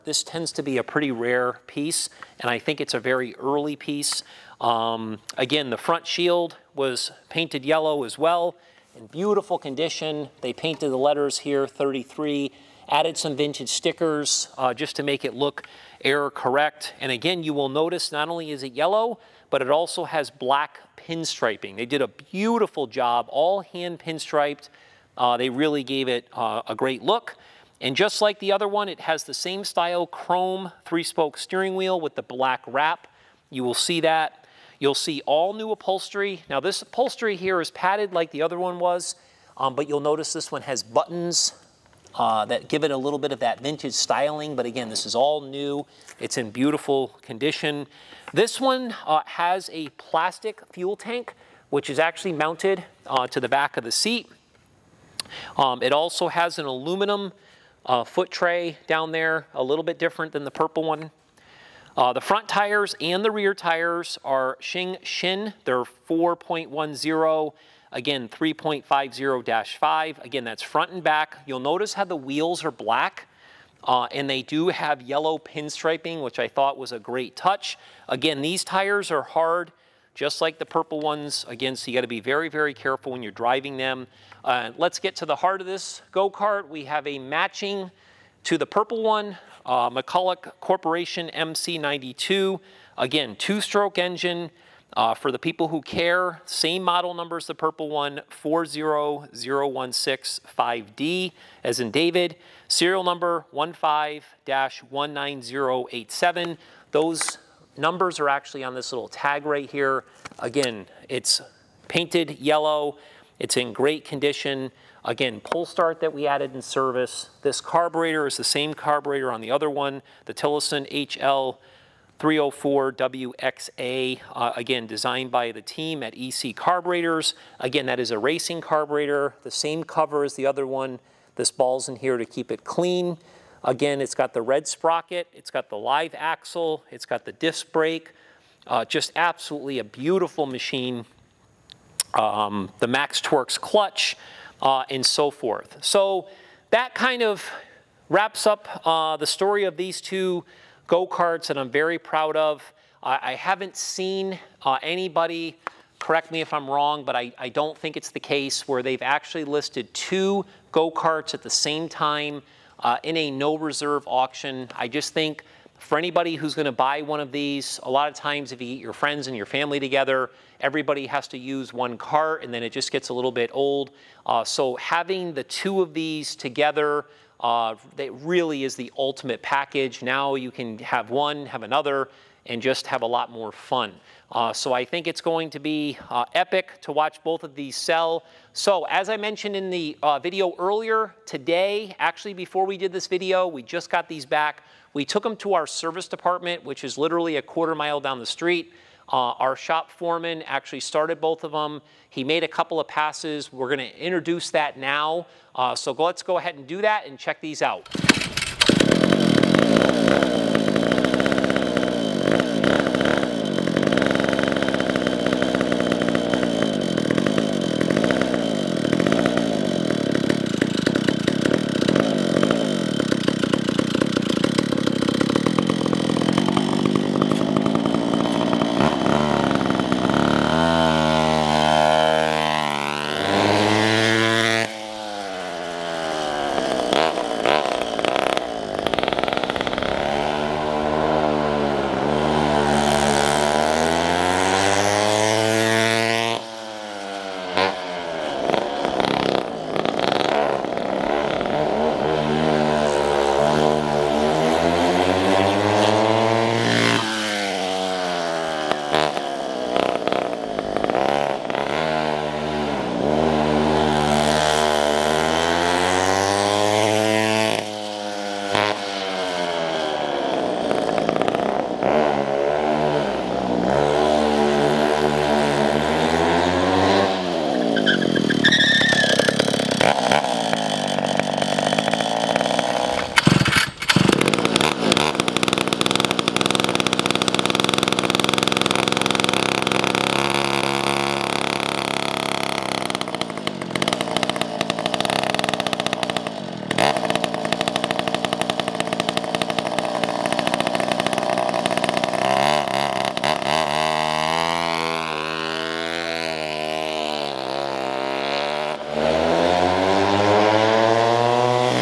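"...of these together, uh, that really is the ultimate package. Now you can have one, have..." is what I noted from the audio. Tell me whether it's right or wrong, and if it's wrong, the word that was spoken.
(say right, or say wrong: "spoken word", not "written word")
right.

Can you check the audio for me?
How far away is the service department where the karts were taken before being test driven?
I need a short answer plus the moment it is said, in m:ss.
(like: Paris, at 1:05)
a quarter mile, at 3:17.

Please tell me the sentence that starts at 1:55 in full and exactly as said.
Again, pull start that we added in service.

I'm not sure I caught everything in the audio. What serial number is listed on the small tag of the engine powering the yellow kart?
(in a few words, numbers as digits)
15-19087.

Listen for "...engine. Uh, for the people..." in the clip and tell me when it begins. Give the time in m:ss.
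1:33.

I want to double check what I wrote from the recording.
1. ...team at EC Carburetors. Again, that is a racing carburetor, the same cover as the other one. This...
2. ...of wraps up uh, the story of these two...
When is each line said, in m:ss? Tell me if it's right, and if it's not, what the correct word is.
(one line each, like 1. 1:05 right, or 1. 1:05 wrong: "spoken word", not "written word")
1. 2:05 right
2. 2:27 right.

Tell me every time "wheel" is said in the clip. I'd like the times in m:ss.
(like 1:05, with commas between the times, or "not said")
0:31, 1:12.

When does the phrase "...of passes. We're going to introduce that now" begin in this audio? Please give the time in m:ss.
3:22.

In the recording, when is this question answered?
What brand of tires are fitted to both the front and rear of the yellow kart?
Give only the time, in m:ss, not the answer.
1:04.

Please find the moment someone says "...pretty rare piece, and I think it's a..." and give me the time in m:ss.
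0:00.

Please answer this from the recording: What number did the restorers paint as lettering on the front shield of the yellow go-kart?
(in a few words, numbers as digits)
33.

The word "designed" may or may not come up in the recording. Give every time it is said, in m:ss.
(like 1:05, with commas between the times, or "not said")
2:04.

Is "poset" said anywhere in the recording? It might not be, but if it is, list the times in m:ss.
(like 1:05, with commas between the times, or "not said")
not said.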